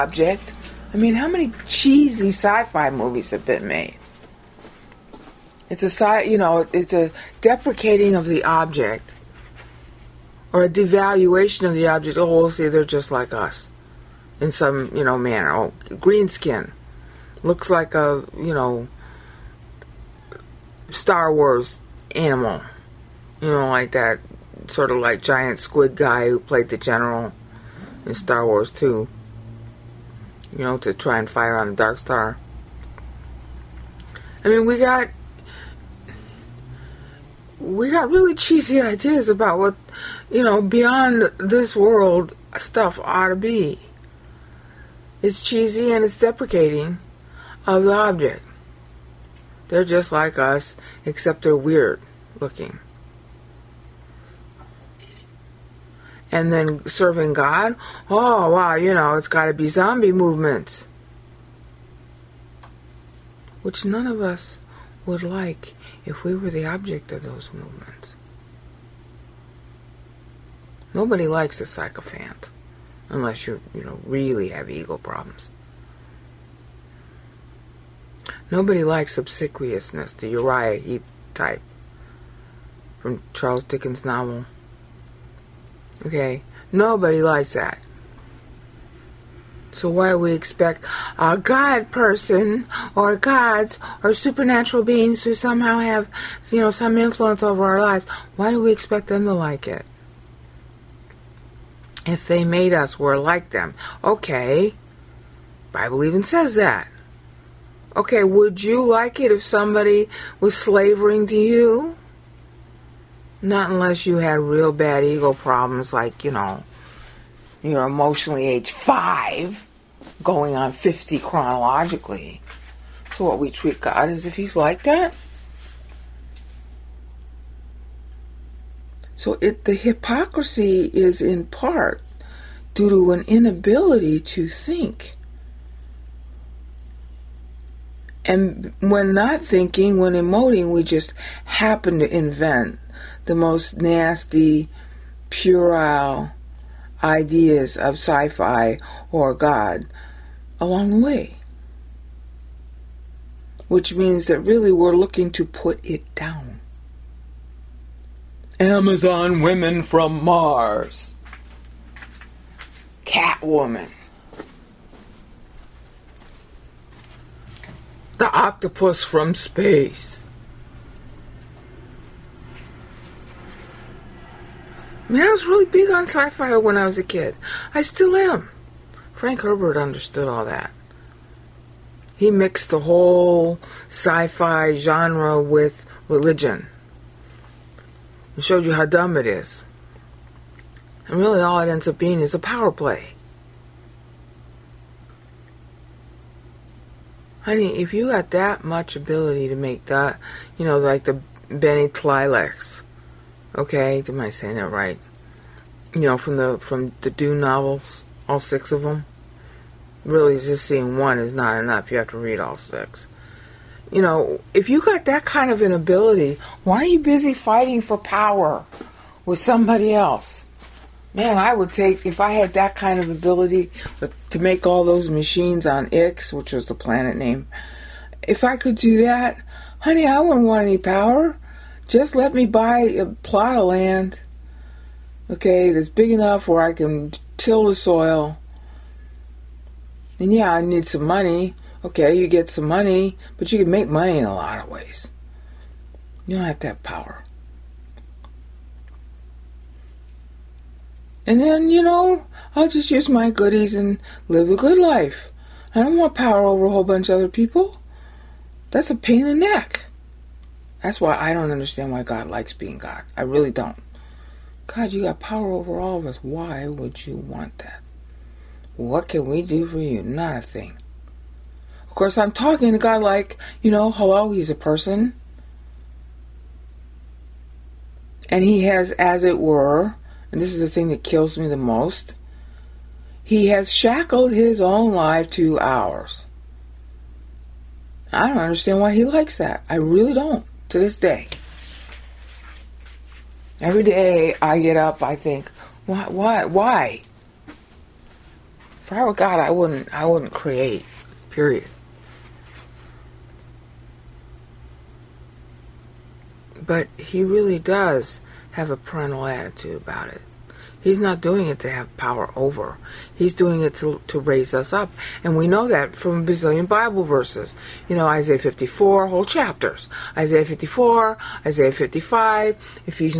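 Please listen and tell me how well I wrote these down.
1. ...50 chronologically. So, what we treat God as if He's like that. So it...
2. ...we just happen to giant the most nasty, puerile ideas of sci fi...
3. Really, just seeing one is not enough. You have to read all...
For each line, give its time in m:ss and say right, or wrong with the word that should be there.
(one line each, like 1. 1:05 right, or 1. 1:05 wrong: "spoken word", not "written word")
1. 2:00 right
2. 2:20 wrong: "invent", not "giant"
3. 3:30 right.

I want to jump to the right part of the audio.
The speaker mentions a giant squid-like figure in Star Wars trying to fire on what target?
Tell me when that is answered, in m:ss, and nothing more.
0:31.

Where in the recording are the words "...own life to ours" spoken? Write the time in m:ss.
4:44.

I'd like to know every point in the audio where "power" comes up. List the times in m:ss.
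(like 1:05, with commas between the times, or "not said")
3:12, 3:37, 3:50, 4:06, 4:16, 4:25, 5:11.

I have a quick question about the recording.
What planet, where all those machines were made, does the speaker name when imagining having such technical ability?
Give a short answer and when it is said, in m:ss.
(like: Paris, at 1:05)
Ix, at 3:45.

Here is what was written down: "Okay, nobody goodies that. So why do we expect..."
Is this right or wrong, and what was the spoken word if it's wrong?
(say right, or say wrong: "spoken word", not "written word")
wrong: "likes", not "goodies".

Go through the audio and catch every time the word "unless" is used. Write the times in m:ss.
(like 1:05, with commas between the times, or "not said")
1:13, 1:53.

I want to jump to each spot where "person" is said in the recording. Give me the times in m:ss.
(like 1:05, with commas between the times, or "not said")
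1:31, 4:34.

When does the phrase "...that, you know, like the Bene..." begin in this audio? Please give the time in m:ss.
3:19.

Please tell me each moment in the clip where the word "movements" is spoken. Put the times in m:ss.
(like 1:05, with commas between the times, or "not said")
1:00, 1:07.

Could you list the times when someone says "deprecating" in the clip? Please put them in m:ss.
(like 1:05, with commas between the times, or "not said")
0:07, 0:46.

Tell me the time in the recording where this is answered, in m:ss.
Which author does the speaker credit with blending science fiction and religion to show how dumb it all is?
2:59.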